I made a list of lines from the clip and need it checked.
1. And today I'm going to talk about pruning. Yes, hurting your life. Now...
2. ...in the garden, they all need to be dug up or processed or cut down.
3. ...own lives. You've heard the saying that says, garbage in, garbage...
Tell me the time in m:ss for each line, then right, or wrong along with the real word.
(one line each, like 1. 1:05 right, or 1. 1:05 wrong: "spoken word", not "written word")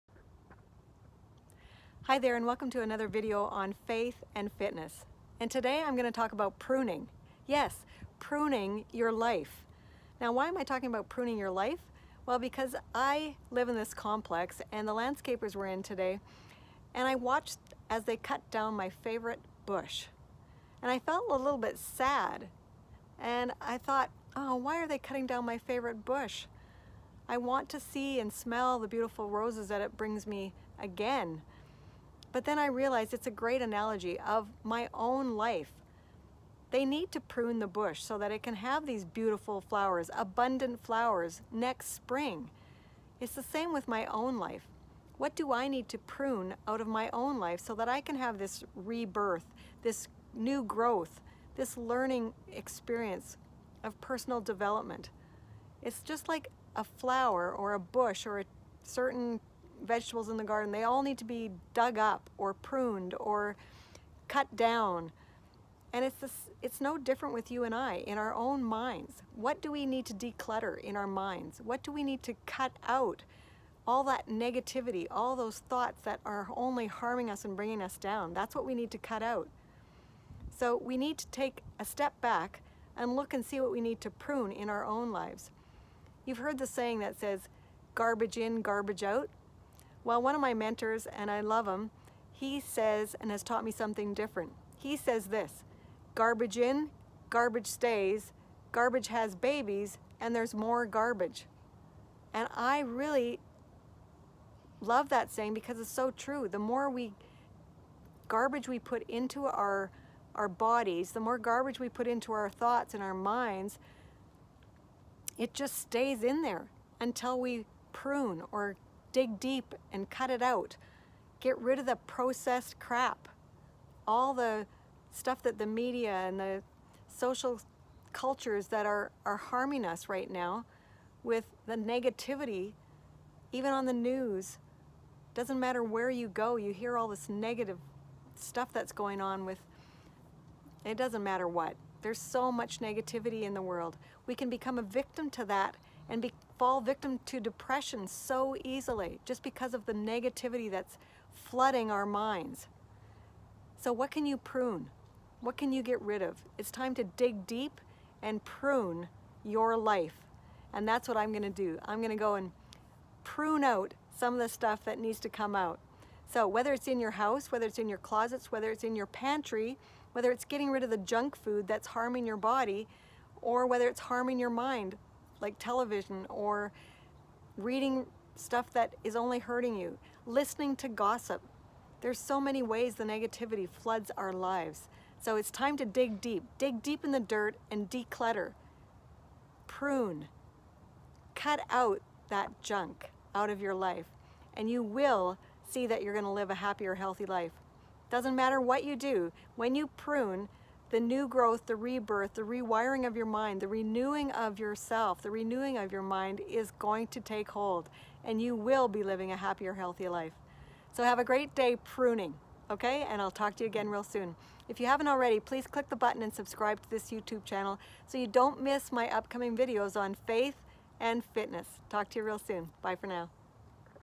1. 0:05 wrong: "pruning", not "hurting"
2. 1:00 wrong: "pruned", not "processed"
3. 1:24 right.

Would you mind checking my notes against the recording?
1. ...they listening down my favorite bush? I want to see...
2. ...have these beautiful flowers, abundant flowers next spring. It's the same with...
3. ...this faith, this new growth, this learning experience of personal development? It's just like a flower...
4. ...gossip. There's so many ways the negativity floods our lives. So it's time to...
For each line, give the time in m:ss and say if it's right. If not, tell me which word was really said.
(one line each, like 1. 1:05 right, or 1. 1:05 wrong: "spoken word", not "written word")
1. 0:24 wrong: "cutting", not "listening"
2. 0:38 right
3. 0:48 wrong: "rebirth", not "faith"
4. 3:00 right.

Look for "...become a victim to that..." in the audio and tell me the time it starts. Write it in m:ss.
2:24.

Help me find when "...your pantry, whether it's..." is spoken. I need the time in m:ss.
2:48.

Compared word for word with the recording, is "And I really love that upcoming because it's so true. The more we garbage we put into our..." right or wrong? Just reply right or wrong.
wrong.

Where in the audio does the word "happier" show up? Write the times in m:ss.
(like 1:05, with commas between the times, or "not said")
3:16, 3:29.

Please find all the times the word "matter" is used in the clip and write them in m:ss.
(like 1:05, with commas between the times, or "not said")
2:15, 2:21, 3:18.